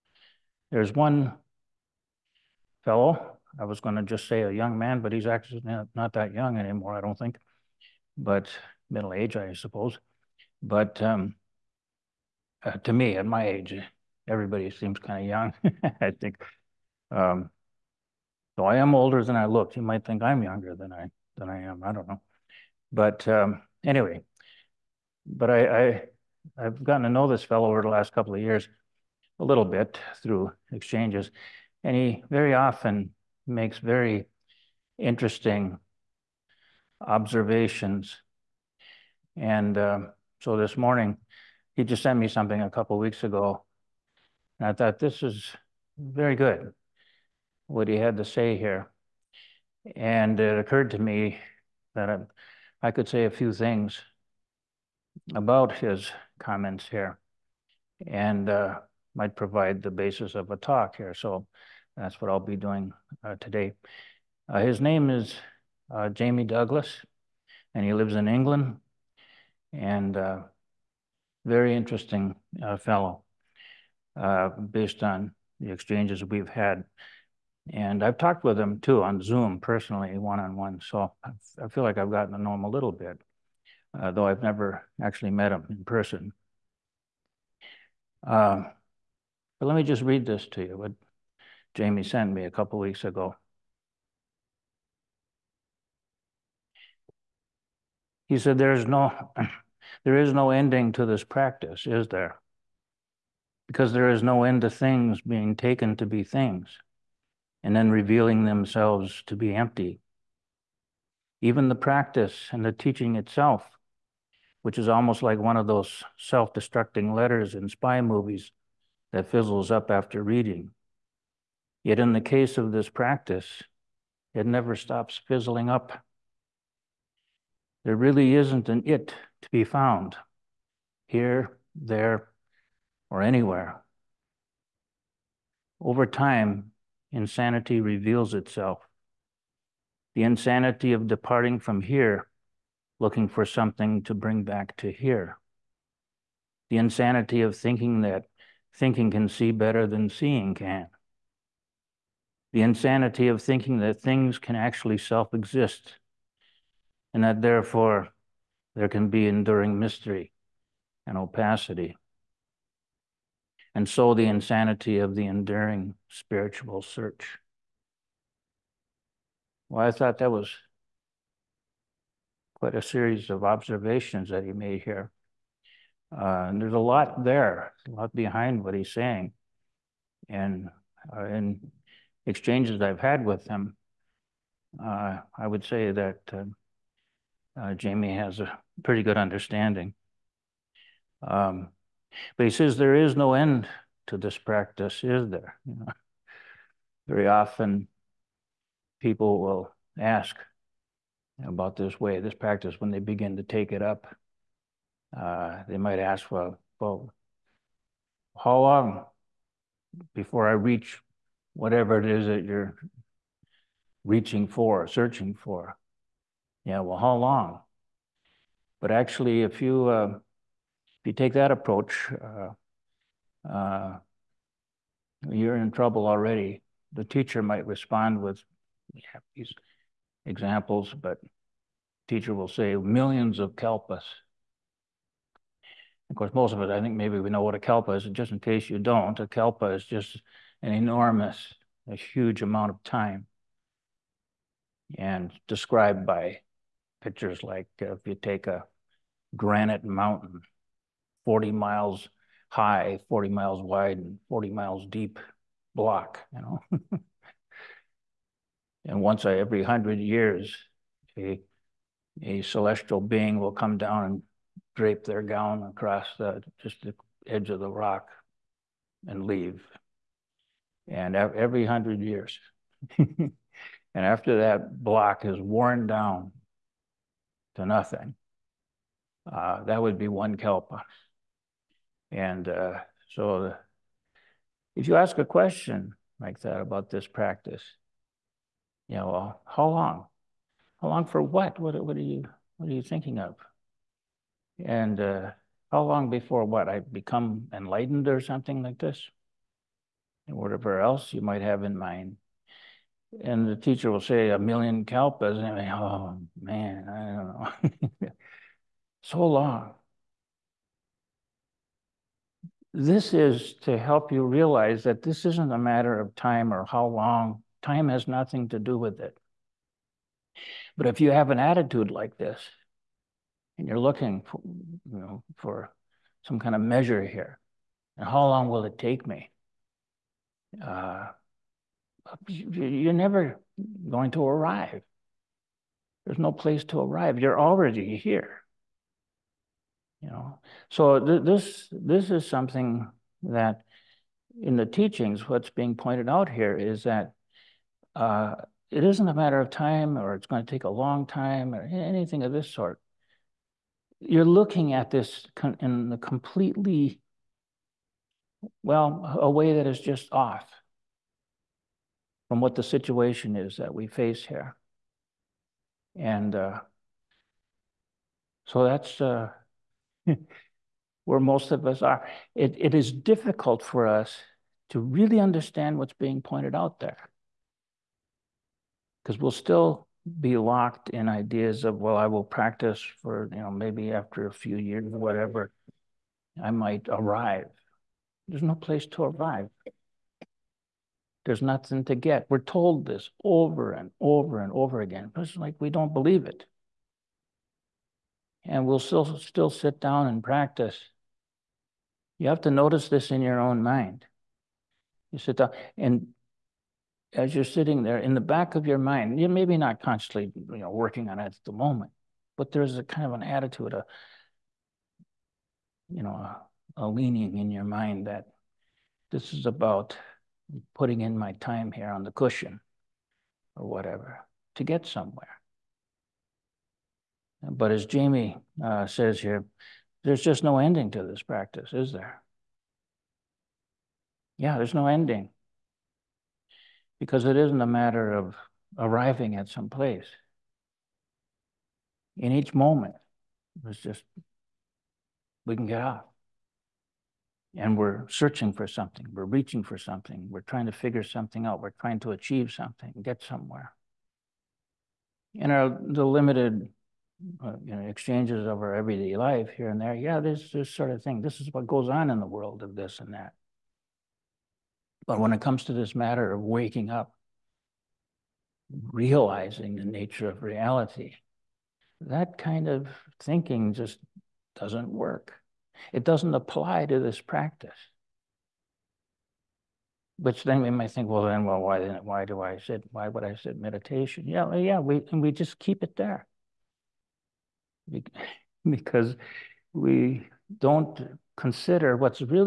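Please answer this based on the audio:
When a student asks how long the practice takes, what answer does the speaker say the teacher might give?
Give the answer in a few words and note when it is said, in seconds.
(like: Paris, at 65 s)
millions of kalpas, at 232 s.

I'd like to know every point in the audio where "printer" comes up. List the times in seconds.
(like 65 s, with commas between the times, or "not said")
not said.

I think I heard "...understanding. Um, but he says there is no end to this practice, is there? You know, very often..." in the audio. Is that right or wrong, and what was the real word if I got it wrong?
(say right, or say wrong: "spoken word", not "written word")
right.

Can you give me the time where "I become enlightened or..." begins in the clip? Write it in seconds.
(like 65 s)
296 s.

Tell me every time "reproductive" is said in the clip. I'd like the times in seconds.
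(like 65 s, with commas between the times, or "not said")
not said.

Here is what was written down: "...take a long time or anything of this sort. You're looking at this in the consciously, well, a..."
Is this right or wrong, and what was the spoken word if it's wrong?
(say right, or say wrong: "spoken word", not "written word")
wrong: "completely", not "consciously".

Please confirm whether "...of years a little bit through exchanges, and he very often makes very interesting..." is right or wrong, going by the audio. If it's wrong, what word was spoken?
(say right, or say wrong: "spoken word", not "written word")
right.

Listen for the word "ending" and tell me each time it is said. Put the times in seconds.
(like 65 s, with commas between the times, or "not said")
100 s, 430 s, 434 s.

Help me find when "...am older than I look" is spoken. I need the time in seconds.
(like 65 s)
18 s.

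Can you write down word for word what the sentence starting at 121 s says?
Yet in the case of this practice, it never stops fizzling up.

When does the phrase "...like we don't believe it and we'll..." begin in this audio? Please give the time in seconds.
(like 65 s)
395 s.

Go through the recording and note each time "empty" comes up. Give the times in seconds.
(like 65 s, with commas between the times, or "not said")
109 s.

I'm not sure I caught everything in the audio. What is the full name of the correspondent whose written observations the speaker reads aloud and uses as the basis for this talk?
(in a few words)
Jamie Douglas.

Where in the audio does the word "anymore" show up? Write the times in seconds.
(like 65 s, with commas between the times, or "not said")
6 s.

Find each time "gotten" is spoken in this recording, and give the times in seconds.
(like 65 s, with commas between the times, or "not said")
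26 s, 82 s.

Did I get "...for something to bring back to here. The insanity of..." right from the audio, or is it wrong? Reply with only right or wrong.
right.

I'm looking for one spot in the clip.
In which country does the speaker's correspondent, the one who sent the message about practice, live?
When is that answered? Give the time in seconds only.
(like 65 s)
68 s.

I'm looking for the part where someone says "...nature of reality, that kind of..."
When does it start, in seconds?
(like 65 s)
469 s.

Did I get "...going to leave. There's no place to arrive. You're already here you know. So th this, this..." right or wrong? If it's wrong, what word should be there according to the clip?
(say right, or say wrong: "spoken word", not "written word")
wrong: "arrive", not "leave".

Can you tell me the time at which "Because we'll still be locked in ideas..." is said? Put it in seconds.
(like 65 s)
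379 s.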